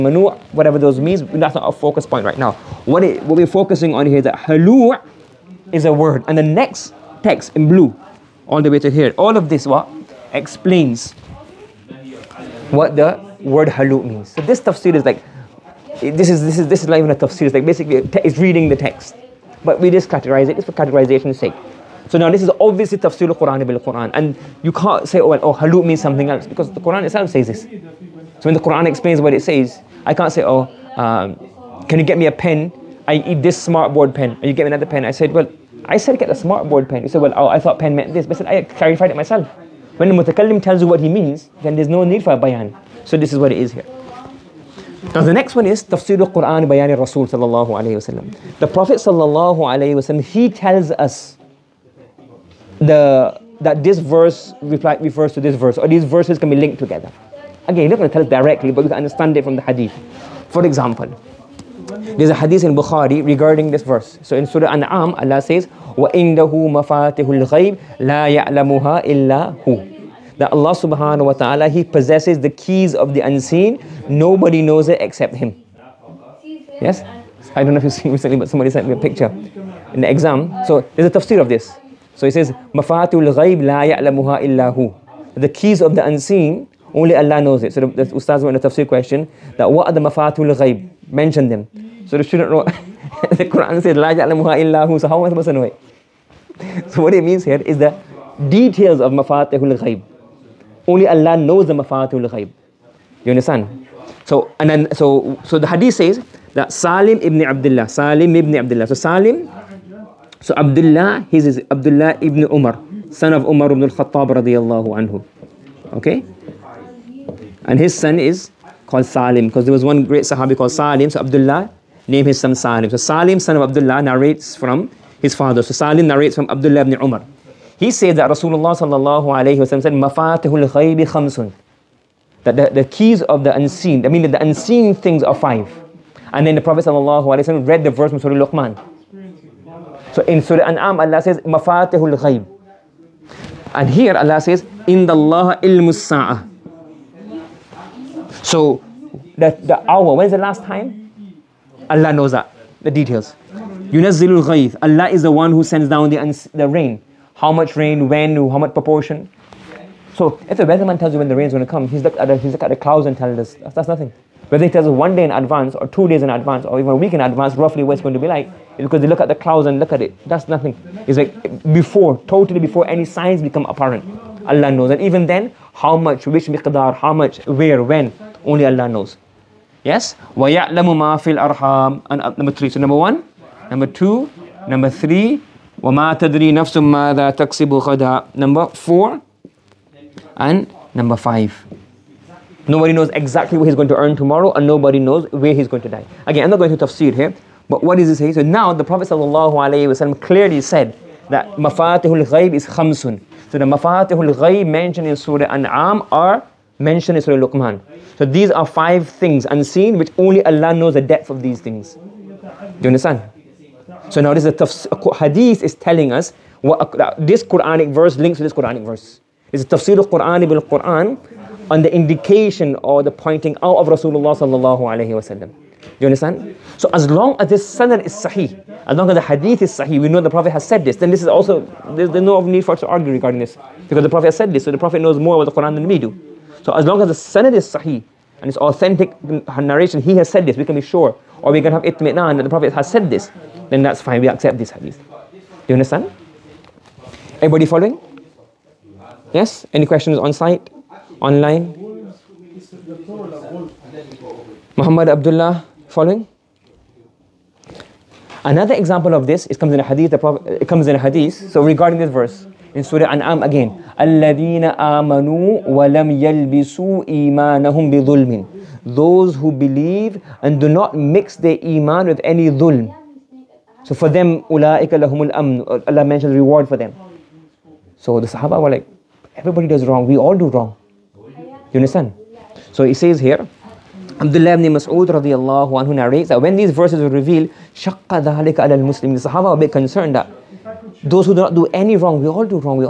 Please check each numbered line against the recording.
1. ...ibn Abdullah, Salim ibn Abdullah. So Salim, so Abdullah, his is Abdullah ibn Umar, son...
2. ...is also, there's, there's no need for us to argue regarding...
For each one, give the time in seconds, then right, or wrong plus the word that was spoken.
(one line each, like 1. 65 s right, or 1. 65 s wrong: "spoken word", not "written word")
1. 107 s right
2. 231 s right.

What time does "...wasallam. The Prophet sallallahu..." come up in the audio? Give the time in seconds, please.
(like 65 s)
47 s.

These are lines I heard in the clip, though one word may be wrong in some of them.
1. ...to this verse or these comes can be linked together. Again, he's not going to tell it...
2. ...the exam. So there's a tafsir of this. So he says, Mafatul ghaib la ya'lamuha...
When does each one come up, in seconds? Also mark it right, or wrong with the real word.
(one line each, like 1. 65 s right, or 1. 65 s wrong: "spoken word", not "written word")
1. 55 s wrong: "verses", not "comes"
2. 80 s right.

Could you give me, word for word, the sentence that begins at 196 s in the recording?
Again, I'm not going to tafsir here, but what does he say?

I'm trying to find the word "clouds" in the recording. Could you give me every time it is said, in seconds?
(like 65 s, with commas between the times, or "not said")
162 s, 169 s.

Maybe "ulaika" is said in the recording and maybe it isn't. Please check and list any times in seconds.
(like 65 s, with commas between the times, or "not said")
274 s.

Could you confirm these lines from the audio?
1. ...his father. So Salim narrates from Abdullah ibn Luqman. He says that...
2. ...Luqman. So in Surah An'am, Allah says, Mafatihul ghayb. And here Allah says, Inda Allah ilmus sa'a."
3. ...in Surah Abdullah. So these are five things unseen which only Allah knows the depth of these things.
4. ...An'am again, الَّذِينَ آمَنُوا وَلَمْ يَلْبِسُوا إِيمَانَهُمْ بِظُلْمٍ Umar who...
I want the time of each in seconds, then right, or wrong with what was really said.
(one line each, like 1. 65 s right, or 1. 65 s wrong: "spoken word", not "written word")
1. 125 s wrong: "Umar", not "Luqman"
2. 138 s right
3. 207 s wrong: "Luqman", not "Abdullah"
4. 263 s wrong: "Those", not "Umar".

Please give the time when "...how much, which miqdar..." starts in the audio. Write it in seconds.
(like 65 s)
175 s.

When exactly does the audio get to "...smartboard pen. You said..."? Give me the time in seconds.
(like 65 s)
36 s.